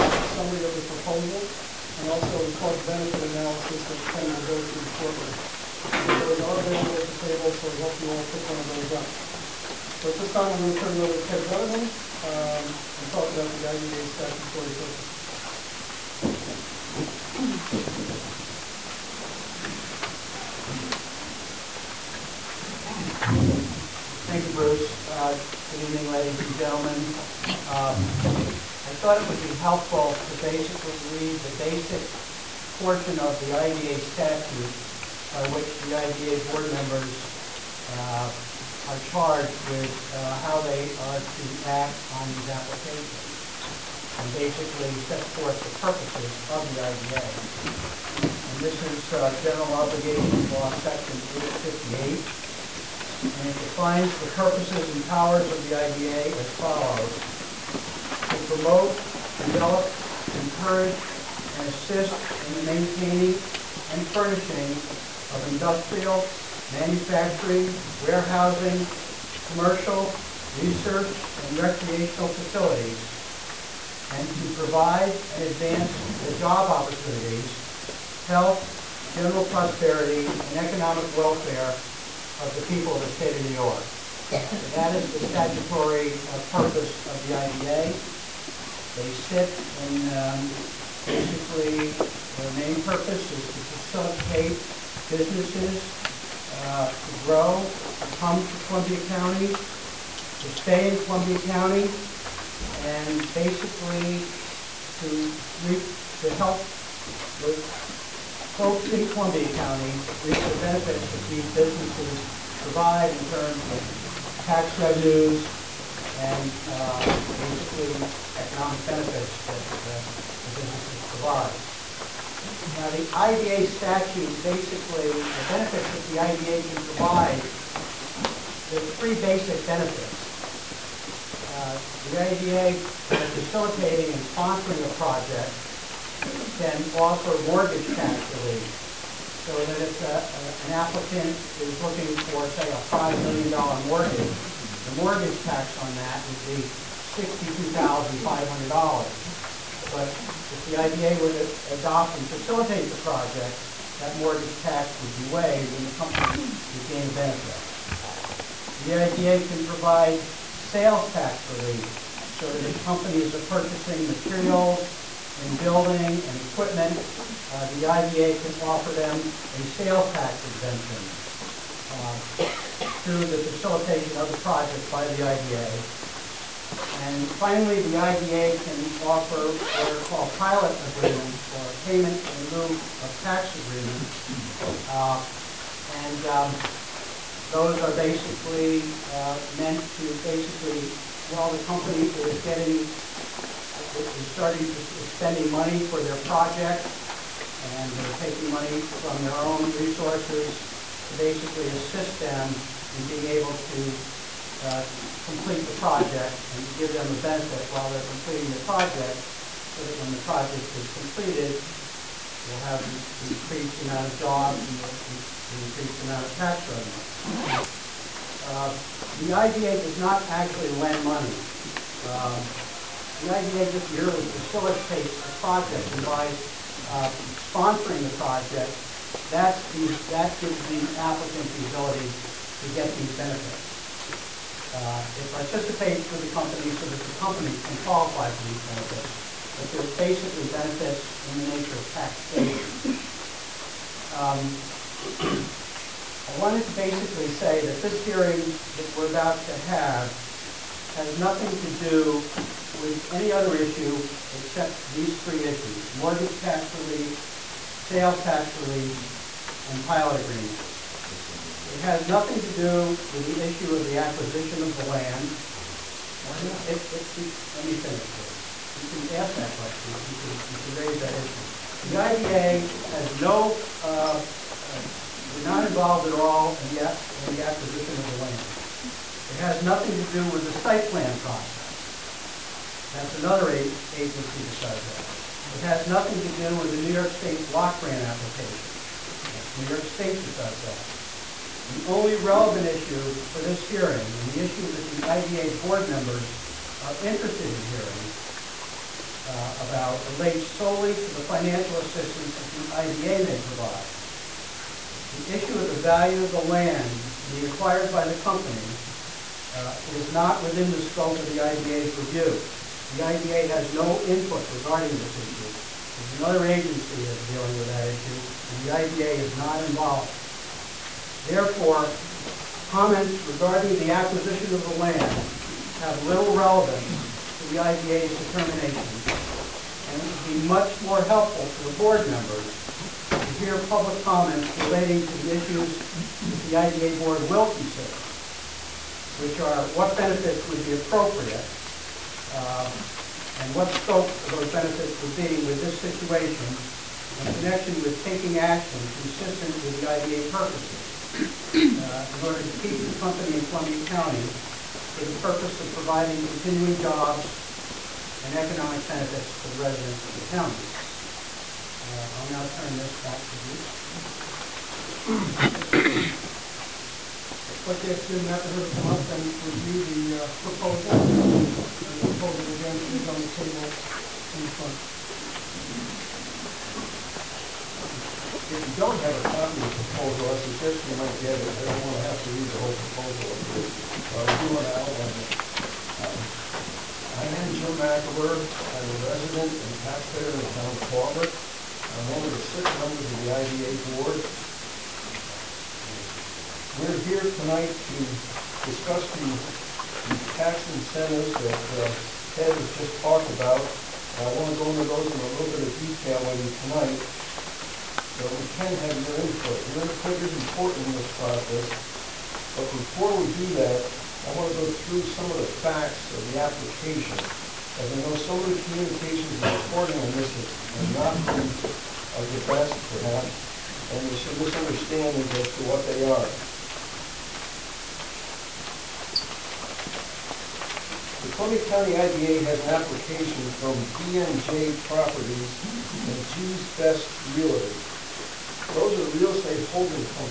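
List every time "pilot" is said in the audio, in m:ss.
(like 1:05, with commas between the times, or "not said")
3:00, 4:19.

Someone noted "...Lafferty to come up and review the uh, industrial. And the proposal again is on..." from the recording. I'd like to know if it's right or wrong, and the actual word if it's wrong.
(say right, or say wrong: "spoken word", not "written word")
wrong: "proposal", not "industrial".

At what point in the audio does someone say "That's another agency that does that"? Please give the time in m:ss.
4:42.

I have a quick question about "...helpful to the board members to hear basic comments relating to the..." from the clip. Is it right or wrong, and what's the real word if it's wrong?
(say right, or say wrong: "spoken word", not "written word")
wrong: "public", not "basic".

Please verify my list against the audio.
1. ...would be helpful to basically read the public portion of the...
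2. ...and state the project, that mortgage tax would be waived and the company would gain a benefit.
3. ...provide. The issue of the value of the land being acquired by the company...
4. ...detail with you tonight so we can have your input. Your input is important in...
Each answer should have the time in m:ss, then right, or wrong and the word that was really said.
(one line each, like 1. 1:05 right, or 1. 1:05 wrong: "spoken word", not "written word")
1. 0:29 wrong: "basic", not "public"
2. 2:32 wrong: "facilitate", not "state"
3. 5:03 right
4. 6:45 right.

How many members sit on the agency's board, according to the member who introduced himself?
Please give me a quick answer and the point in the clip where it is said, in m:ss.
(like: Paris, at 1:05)
6, at 6:32.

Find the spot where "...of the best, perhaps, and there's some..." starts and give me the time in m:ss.
7:02.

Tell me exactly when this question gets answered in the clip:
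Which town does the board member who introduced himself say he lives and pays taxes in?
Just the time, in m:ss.
6:30.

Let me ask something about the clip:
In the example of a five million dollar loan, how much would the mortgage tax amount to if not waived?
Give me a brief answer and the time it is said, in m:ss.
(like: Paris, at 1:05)
$62,500, at 2:27.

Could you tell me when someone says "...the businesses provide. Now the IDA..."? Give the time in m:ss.
2:00.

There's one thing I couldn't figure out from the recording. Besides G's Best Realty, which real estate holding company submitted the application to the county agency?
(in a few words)
BNJ Properties.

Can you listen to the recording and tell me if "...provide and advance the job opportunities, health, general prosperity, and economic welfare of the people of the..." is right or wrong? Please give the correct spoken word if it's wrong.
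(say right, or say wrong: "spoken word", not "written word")
right.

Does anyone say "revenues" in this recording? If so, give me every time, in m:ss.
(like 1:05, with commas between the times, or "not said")
1:54, 3:36.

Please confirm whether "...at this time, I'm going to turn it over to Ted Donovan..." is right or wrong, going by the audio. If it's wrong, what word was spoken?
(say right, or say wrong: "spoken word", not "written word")
right.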